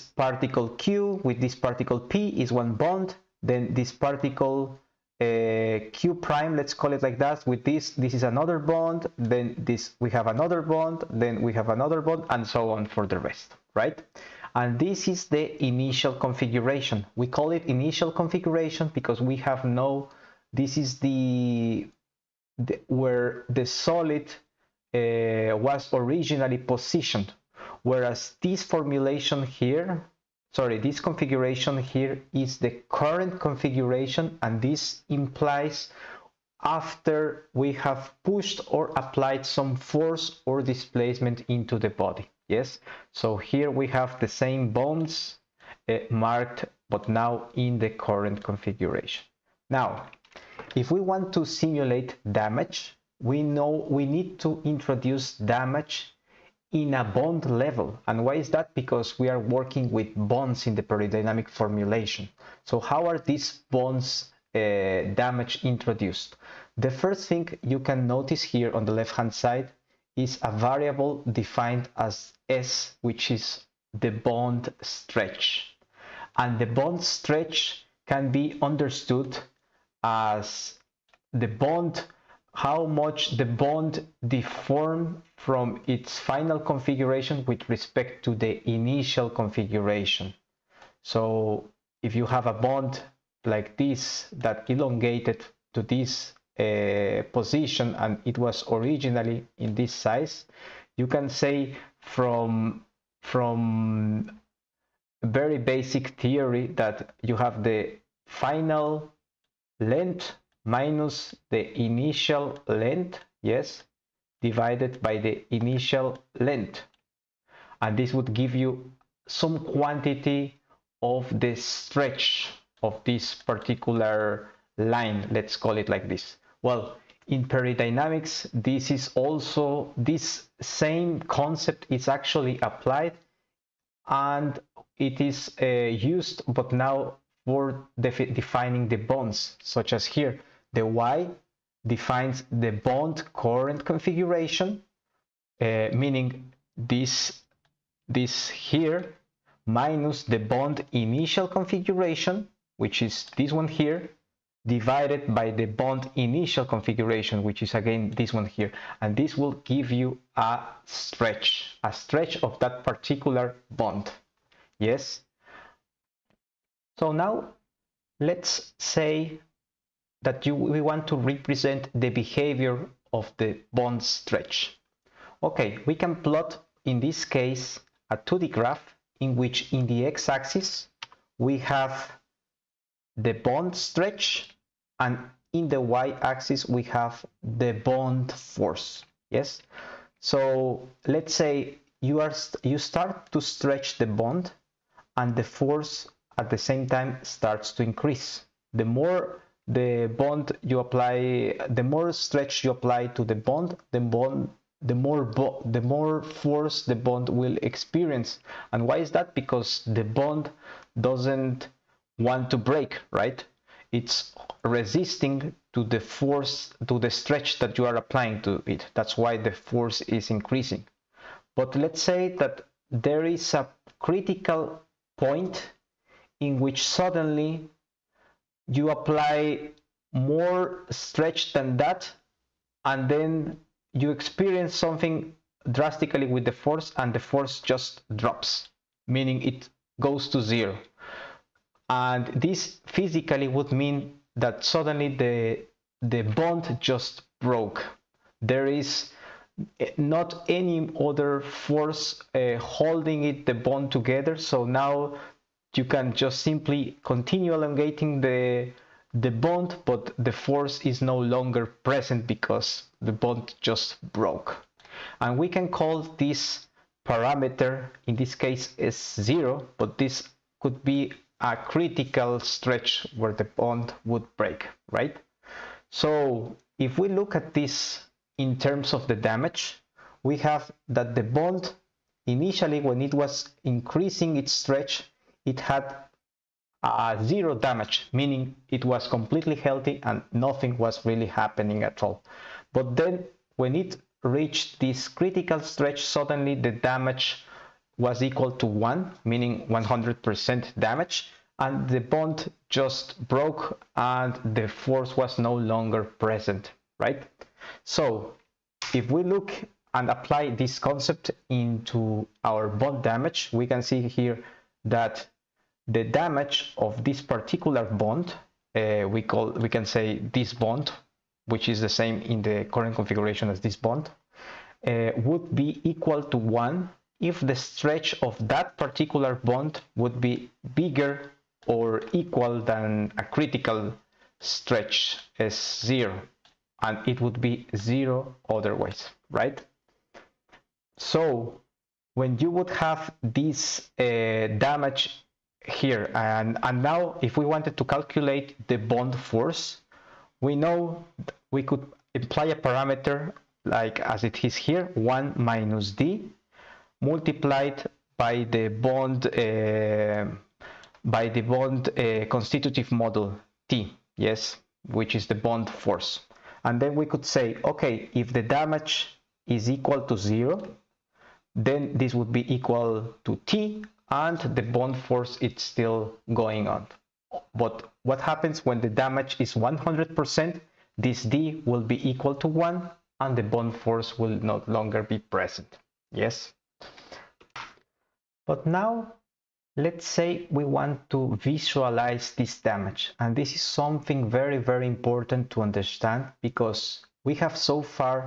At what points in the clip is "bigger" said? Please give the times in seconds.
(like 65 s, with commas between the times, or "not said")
330 s.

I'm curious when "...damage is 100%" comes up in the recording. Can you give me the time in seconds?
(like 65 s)
378 s.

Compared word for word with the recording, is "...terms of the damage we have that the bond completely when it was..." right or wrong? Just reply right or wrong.
wrong.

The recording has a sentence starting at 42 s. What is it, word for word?
Yes, so here we have the same bones uh, marked, but now in the current configuration.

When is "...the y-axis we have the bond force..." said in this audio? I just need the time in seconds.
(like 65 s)
185 s.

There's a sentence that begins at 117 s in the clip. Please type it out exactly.
And this would give you some quantity of the stretch of this particular line, let's call it like this.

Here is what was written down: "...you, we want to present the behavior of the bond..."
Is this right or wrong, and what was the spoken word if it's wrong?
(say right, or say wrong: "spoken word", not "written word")
wrong: "represent", not "present".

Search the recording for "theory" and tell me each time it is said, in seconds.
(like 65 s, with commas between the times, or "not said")
106 s.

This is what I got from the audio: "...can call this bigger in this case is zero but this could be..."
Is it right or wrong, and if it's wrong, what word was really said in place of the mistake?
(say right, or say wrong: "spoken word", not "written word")
wrong: "parameter", not "bigger".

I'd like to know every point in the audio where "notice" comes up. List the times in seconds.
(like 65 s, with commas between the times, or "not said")
68 s.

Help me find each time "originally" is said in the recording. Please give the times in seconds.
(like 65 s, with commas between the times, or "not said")
25 s, 98 s.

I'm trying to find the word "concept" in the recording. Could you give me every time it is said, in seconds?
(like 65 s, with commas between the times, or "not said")
131 s, 310 s.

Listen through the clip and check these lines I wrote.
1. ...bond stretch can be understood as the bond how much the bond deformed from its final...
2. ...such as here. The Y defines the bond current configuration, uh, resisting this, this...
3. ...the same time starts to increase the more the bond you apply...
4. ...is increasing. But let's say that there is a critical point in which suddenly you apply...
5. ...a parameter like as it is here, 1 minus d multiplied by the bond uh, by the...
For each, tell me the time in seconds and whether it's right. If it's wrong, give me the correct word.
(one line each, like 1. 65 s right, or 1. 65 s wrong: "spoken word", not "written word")
1. 76 s right
2. 139 s wrong: "meaning", not "resisting"
3. 196 s right
4. 220 s right
5. 352 s right.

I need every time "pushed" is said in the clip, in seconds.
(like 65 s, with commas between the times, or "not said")
38 s.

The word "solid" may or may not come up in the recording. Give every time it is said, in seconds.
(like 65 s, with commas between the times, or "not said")
23 s.